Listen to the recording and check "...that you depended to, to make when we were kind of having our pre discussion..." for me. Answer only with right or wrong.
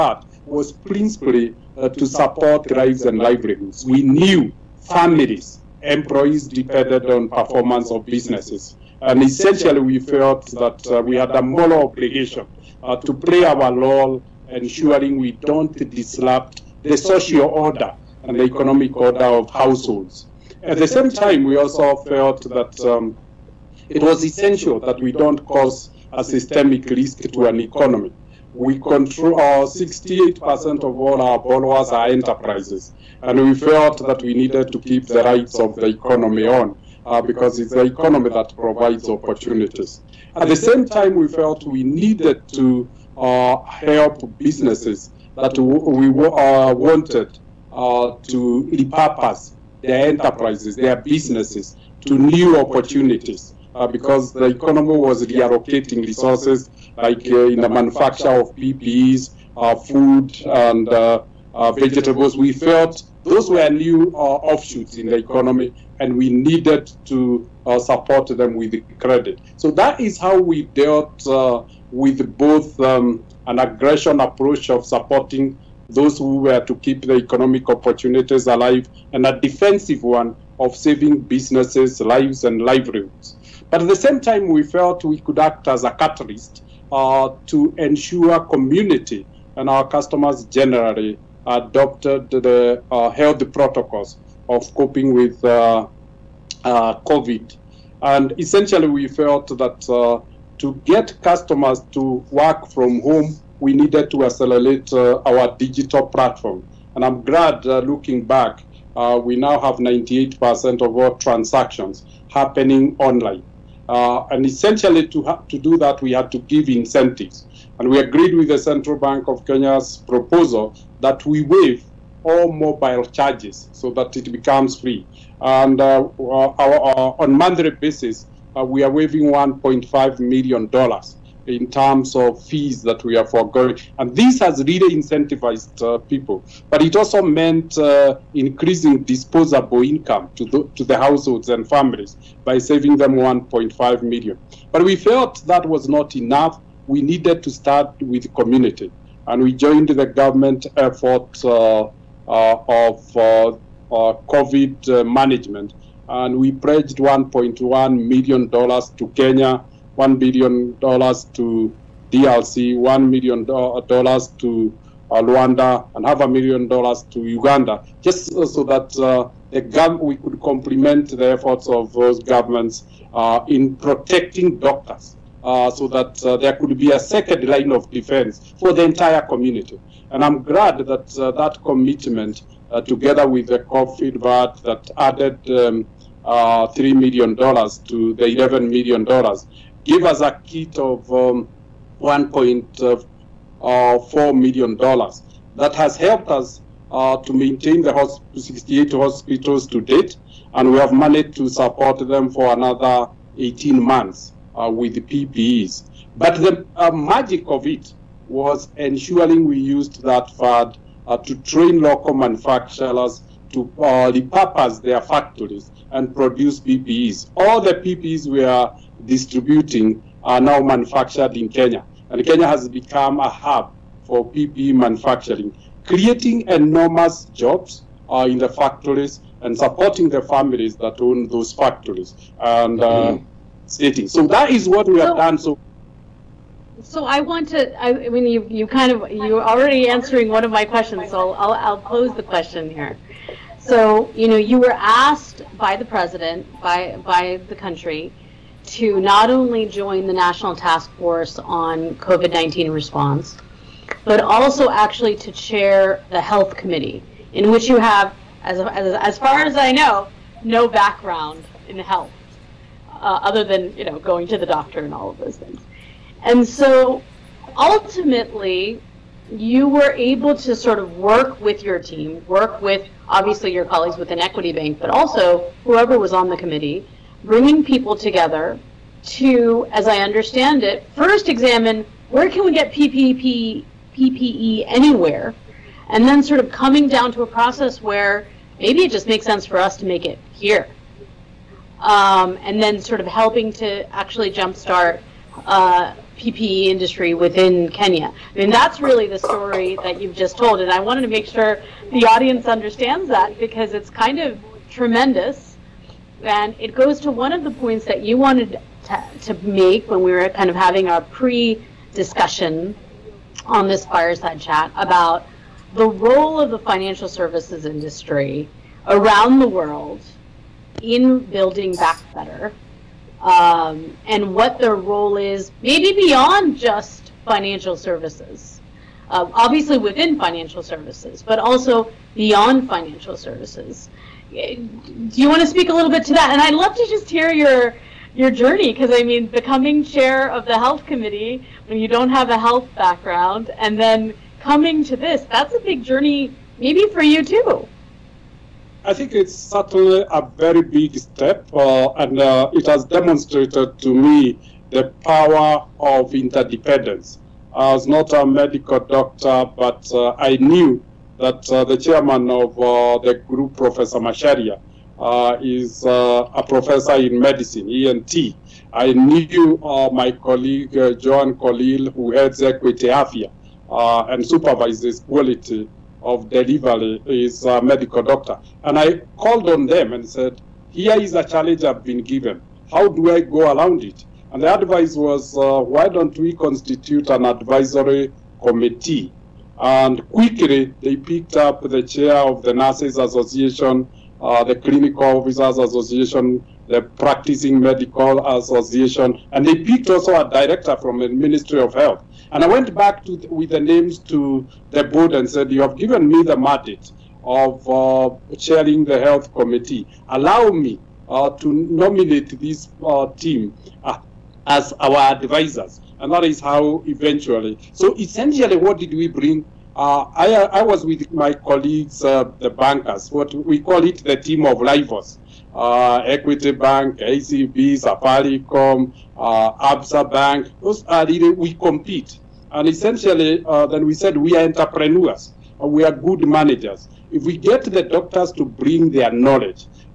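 wrong.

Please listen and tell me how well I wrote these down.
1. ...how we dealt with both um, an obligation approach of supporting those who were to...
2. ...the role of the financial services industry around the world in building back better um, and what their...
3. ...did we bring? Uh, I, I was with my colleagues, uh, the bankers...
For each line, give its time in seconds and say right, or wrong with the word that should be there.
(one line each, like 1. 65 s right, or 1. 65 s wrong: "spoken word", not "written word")
1. 70 s wrong: "aggression", not "obligation"
2. 315 s right
3. 418 s right.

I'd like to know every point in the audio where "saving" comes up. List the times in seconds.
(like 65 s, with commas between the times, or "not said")
80 s, 142 s.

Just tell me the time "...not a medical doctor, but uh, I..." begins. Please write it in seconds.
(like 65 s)
357 s.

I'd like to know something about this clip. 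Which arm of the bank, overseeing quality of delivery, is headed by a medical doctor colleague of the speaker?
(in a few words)
Equity Afia.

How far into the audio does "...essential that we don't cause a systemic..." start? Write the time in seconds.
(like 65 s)
24 s.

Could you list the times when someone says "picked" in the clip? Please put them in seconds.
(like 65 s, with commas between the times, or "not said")
390 s, 399 s.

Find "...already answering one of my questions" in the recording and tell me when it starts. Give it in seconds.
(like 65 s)
239 s.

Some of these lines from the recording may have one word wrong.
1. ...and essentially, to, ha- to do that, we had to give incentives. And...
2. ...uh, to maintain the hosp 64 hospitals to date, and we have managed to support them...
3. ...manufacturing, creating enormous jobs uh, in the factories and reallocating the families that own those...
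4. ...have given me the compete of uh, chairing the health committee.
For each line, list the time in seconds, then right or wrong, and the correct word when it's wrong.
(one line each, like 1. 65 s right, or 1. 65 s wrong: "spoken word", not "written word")
1. 114 s right
2. 196 s wrong: "68", not "64"
3. 224 s wrong: "supporting", not "reallocating"
4. 405 s wrong: "mandate", not "compete".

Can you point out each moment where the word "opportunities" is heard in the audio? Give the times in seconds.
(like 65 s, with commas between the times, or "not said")
39 s, 52 s, 77 s.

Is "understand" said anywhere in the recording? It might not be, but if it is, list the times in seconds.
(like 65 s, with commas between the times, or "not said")
279 s, 302 s.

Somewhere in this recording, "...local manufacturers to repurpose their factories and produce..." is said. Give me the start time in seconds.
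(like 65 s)
211 s.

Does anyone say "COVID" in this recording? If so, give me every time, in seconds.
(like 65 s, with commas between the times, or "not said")
96 s, 154 s, 183 s, 251 s.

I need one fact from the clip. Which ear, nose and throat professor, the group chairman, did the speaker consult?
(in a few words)
Professor Macharia.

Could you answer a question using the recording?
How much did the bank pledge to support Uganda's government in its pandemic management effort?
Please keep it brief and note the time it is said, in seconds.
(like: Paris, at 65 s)
half a million dollars, at 166 s.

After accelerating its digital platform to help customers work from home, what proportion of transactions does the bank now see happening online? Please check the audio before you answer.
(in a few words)
98%.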